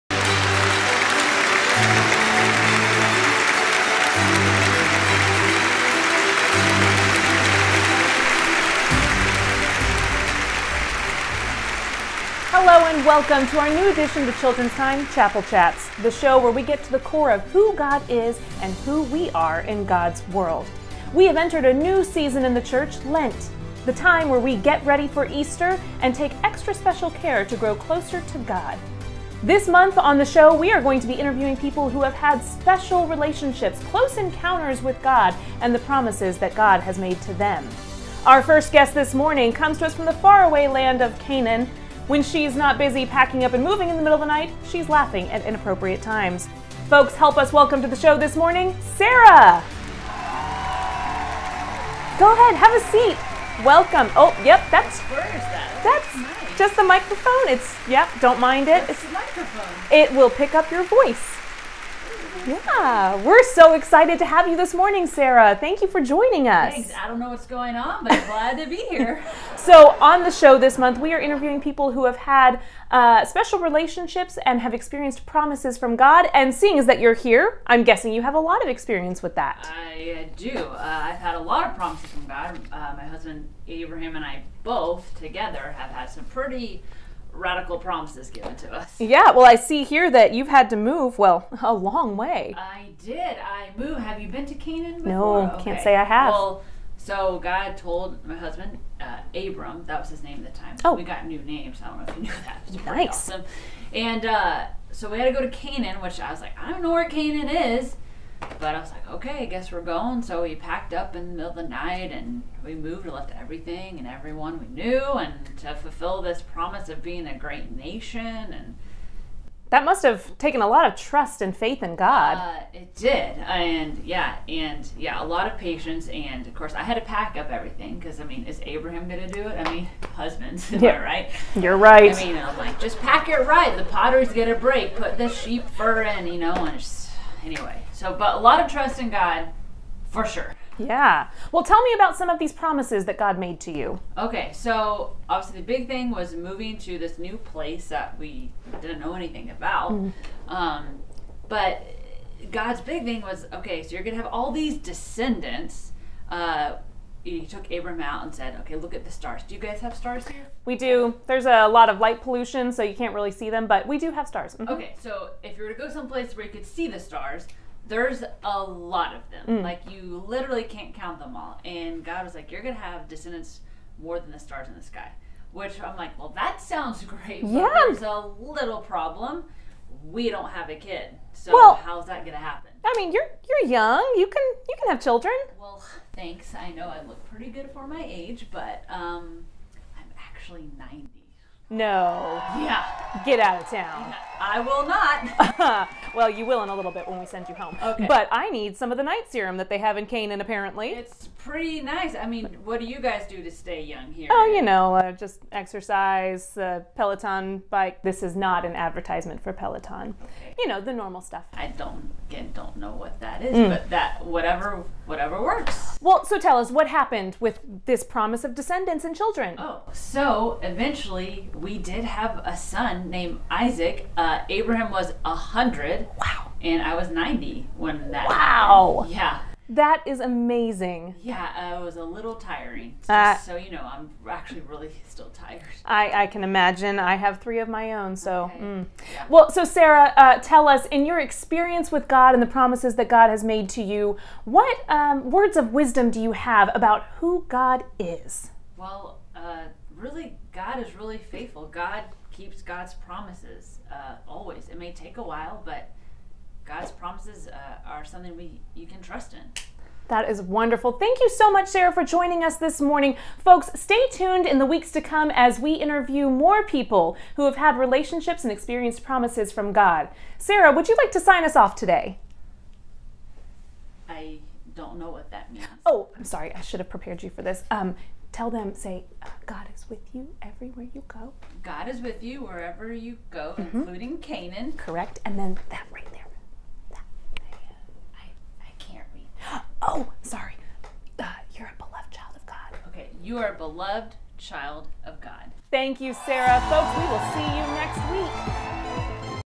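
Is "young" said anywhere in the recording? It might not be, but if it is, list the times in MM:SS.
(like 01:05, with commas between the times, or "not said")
03:03, 03:23.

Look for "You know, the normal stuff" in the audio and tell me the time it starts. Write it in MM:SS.
03:30.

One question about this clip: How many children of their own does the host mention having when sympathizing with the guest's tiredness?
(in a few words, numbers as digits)
3.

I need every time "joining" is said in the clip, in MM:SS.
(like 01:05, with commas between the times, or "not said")
01:06, 04:22.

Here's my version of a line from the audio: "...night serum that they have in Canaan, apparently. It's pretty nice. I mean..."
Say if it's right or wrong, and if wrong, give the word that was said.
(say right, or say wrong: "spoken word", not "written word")
right.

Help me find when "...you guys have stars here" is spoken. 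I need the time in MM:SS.
02:39.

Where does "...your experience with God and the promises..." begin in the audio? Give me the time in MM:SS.
04:01.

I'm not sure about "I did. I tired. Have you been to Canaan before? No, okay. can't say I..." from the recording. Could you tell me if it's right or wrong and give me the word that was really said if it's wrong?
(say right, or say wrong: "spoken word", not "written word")
wrong: "moved", not "tired".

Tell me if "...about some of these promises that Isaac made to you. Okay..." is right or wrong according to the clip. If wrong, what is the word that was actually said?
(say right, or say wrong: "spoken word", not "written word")
wrong: "God", not "Isaac".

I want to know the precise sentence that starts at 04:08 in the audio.
Well, uh, really, God is really faithful.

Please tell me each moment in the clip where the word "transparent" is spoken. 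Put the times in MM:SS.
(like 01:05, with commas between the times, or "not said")
not said.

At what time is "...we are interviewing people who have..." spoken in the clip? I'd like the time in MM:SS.
01:10.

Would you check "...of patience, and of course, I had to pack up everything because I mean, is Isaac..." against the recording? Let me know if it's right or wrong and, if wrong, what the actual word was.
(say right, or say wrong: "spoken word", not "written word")
wrong: "Abraham", not "Isaac".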